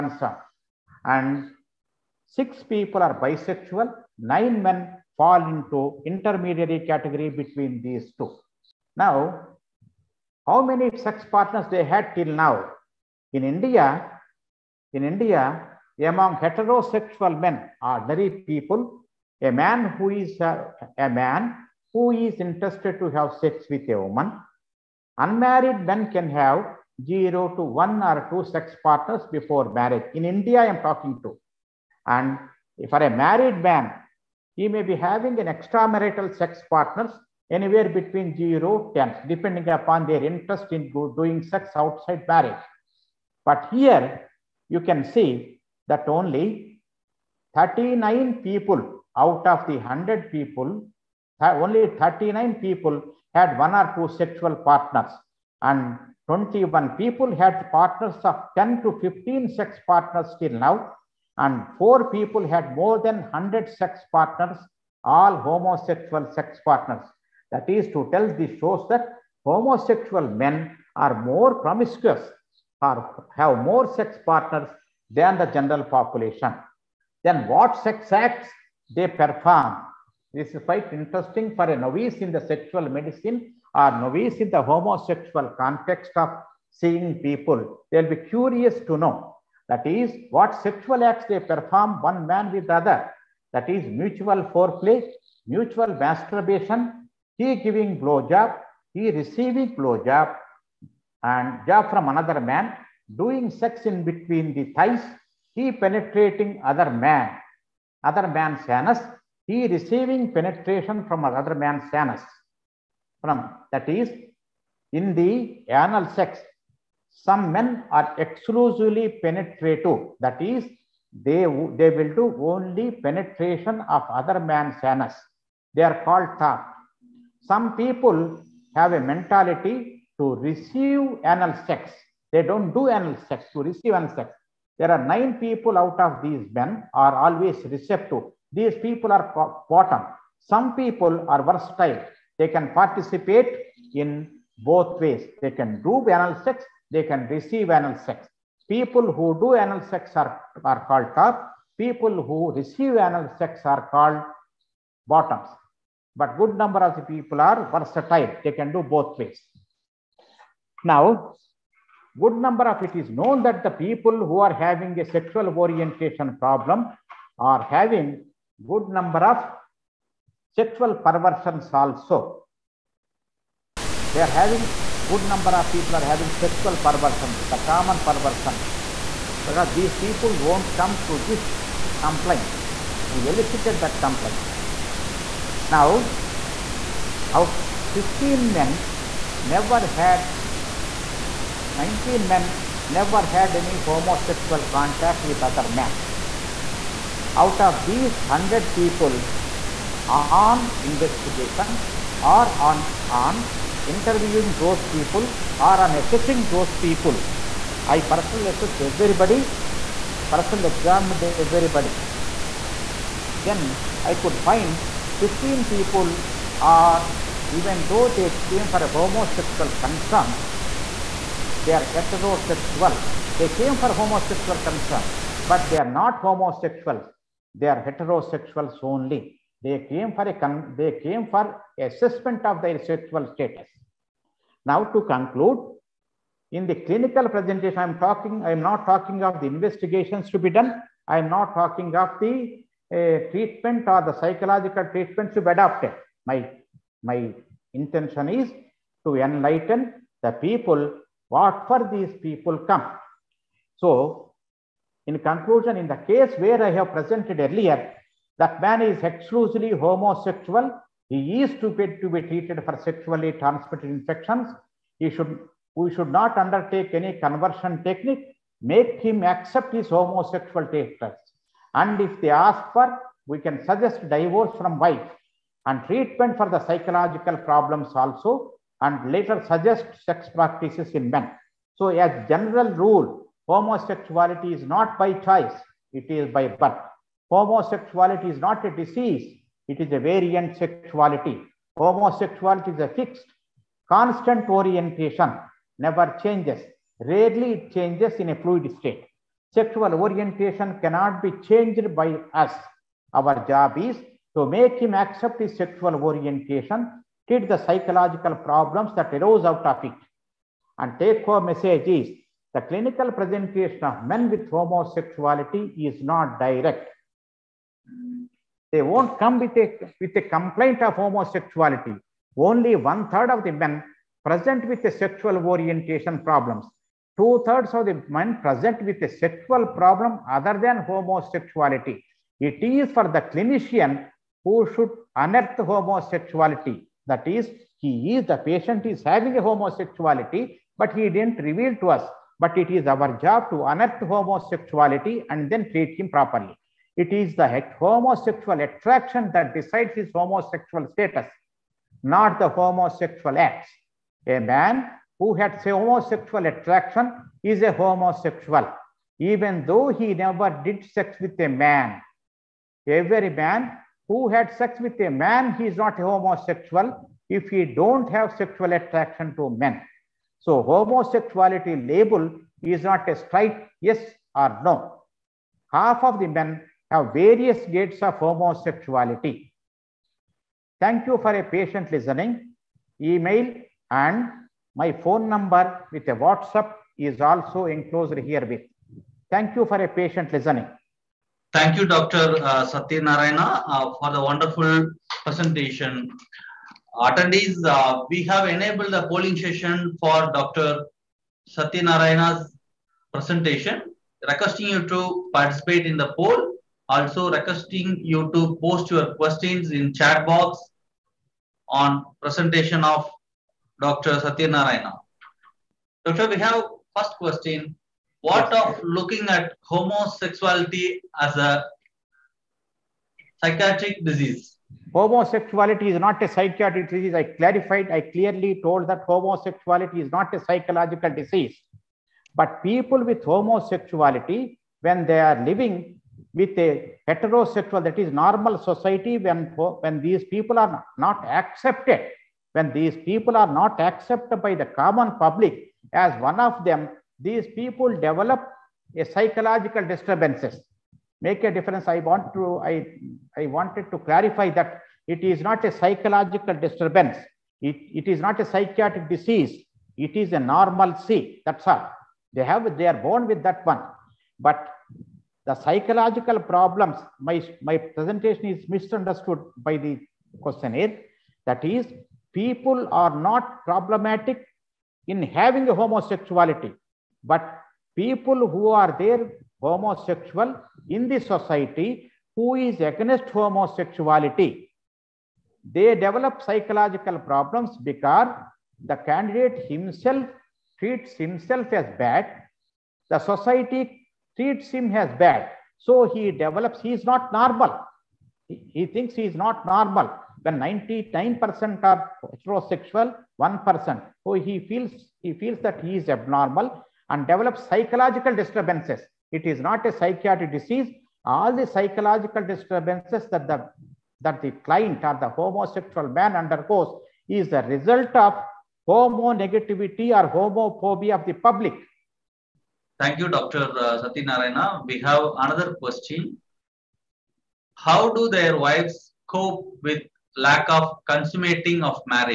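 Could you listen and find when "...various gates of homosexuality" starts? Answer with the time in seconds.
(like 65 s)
377 s.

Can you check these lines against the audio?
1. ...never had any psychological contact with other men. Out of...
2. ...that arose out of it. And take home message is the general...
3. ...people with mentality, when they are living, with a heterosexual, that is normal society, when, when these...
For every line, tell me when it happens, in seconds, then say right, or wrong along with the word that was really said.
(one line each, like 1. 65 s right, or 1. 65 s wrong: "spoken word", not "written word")
1. 192 s wrong: "homosexual", not "psychological"
2. 308 s wrong: "clinical", not "general"
3. 432 s wrong: "homosexuality", not "mentality".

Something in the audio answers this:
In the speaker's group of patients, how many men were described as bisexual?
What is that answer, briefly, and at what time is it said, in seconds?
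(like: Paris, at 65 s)
6, at 2 s.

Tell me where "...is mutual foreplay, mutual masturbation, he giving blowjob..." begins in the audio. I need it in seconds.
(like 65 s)
93 s.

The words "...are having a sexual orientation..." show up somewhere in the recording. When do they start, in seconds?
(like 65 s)
164 s.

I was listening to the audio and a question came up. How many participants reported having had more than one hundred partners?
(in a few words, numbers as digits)
4.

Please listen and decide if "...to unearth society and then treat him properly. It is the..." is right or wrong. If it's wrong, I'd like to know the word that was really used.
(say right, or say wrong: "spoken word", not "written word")
wrong: "homosexuality", not "society".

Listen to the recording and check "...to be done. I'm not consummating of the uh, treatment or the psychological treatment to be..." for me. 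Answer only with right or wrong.
wrong.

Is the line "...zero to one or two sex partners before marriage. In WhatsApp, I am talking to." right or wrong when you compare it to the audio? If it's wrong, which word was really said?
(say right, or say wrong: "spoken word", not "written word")
wrong: "India", not "WhatsApp".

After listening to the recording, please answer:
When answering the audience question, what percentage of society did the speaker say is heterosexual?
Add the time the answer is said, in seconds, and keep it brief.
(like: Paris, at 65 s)
99%, at 500 s.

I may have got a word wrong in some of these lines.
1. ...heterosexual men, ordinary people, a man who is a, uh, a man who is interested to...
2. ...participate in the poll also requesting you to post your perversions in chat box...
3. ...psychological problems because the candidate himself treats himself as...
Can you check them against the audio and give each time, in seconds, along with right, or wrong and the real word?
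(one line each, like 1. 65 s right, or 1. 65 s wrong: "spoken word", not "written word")
1. 16 s right
2. 405 s wrong: "questions", not "perversions"
3. 486 s right.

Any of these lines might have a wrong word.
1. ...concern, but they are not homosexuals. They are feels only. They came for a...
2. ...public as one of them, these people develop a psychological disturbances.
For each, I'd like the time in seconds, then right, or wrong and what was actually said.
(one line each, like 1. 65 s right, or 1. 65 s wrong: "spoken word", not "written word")
1. 224 s wrong: "heterosexuals", not "feels"
2. 445 s right.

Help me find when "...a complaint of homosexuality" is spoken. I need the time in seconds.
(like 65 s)
320 s.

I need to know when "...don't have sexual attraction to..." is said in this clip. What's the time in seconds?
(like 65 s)
367 s.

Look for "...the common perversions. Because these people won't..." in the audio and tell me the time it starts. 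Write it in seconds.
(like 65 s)
177 s.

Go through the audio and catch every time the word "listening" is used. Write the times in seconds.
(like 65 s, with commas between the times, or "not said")
381 s, 390 s.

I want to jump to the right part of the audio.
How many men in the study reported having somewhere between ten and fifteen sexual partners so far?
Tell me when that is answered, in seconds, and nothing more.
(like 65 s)
56 s.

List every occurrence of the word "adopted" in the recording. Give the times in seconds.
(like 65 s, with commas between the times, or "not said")
245 s.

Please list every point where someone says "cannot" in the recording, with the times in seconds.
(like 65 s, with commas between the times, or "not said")
300 s.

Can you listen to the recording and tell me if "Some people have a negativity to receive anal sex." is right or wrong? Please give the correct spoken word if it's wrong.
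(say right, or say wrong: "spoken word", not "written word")
wrong: "mentality", not "negativity".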